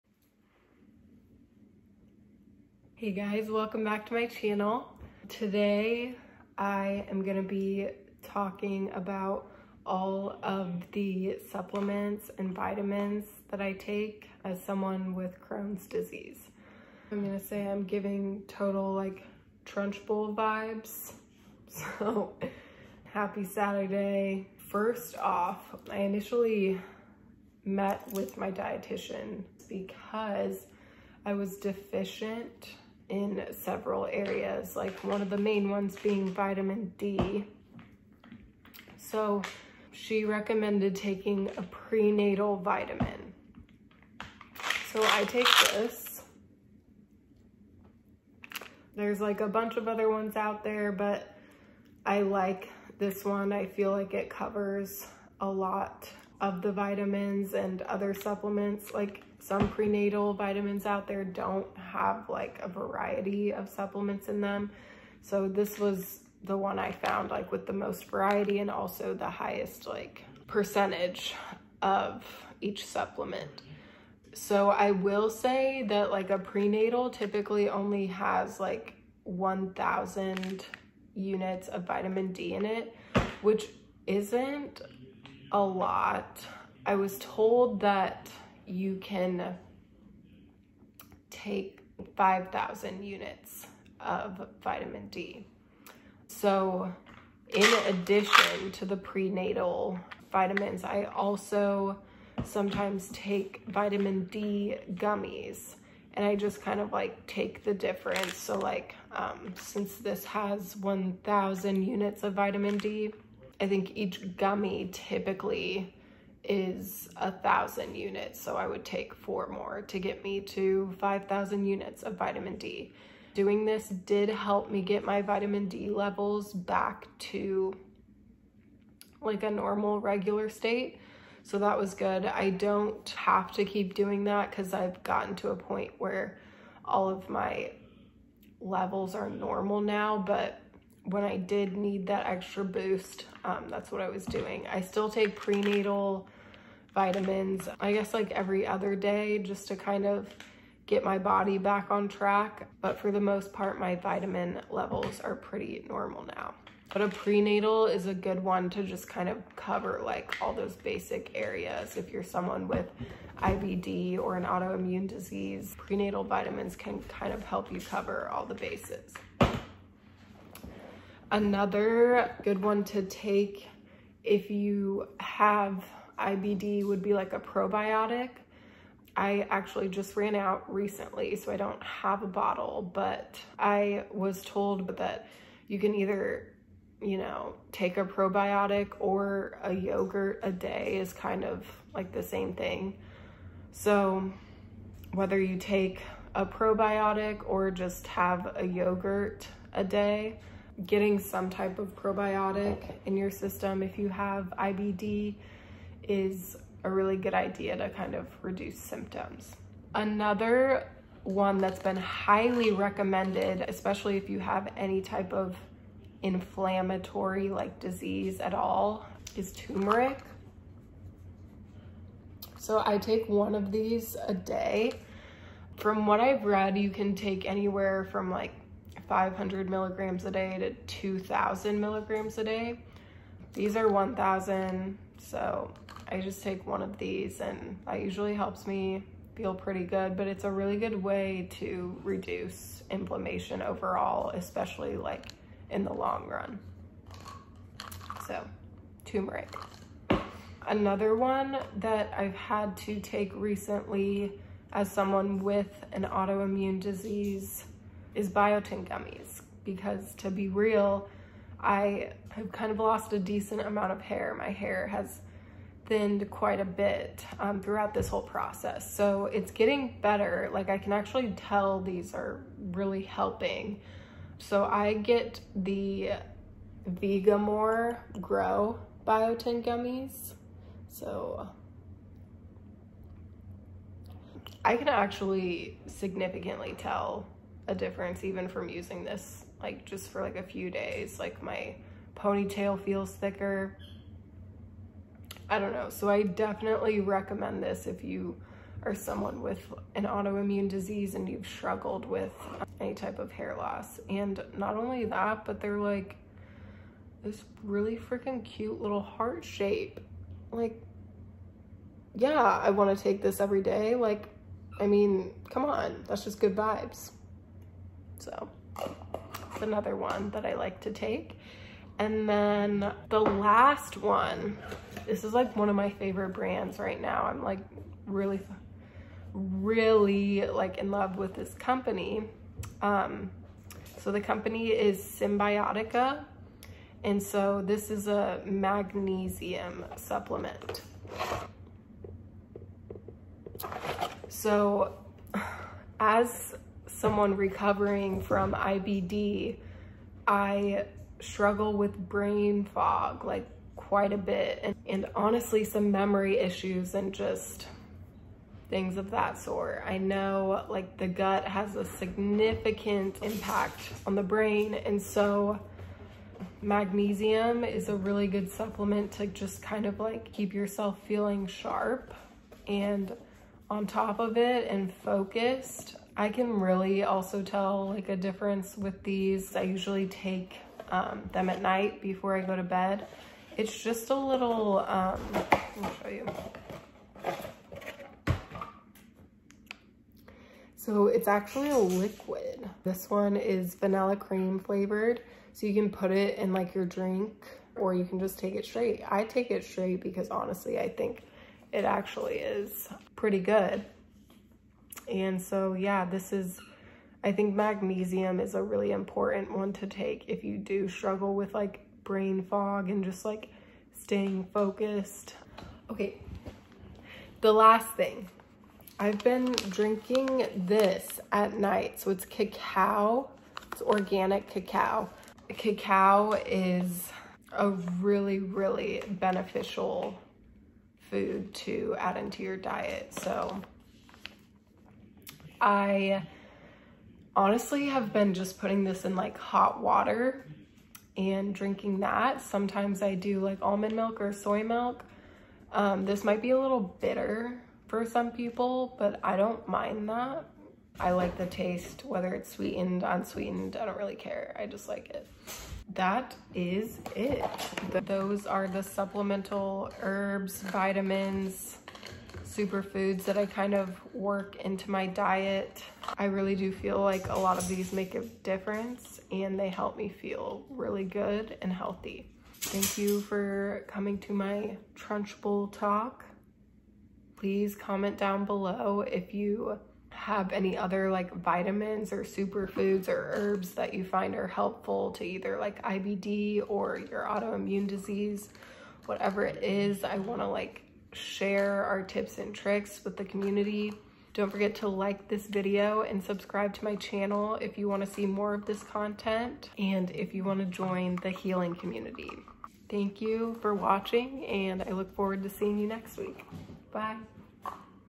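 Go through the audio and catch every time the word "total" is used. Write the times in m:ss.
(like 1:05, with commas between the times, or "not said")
0:18.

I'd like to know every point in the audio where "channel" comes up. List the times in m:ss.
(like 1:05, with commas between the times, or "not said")
0:04, 8:16.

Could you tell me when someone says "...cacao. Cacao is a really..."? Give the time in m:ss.
7:04.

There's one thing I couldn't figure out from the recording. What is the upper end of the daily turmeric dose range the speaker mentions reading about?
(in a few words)
2,000 milligrams.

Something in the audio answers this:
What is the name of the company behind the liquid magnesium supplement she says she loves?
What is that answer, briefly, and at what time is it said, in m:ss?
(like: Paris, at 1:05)
Cymbiotika, at 5:35.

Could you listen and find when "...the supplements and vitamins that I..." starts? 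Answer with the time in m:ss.
0:10.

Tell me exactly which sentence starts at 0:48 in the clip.
There's like a bunch of other ones out there, but I like this one.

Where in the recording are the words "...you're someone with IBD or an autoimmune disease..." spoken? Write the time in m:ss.
2:42.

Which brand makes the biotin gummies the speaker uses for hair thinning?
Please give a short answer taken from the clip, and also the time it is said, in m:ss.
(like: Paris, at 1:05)
Vegamour, at 4:36.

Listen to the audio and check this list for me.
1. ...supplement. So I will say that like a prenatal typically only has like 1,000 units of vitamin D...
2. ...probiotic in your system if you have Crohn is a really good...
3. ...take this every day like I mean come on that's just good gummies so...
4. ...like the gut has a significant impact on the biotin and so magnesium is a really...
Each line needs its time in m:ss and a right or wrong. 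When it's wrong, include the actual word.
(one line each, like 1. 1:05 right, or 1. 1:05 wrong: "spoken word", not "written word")
1. 1:12 right
2. 3:21 wrong: "IBD", not "Crohn"
3. 5:13 wrong: "vibes", not "gummies"
4. 6:00 wrong: "brain", not "biotin".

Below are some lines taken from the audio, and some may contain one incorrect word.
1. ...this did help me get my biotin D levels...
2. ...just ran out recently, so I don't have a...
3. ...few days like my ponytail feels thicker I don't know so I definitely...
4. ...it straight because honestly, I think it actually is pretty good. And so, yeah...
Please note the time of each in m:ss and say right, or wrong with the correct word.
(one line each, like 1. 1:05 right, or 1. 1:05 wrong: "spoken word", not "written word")
1. 2:03 wrong: "vitamin", not "biotin"
2. 2:59 right
3. 4:50 right
4. 6:39 right.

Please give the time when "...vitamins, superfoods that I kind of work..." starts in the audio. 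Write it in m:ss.
7:40.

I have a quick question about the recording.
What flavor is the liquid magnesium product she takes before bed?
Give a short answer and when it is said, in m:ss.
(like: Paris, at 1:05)
vanilla cream, at 6:33.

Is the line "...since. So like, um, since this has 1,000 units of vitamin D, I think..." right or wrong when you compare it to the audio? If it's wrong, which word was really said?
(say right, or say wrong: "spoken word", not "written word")
wrong: "difference", not "since".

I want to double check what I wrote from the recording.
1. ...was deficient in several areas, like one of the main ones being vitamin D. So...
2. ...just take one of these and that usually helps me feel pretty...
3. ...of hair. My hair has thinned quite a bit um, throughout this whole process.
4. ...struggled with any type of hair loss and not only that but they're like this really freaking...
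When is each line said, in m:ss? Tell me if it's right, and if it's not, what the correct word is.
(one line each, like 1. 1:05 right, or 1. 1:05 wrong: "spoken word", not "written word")
1. 0:31 right
2. 3:56 right
3. 4:23 right
4. 5:01 right.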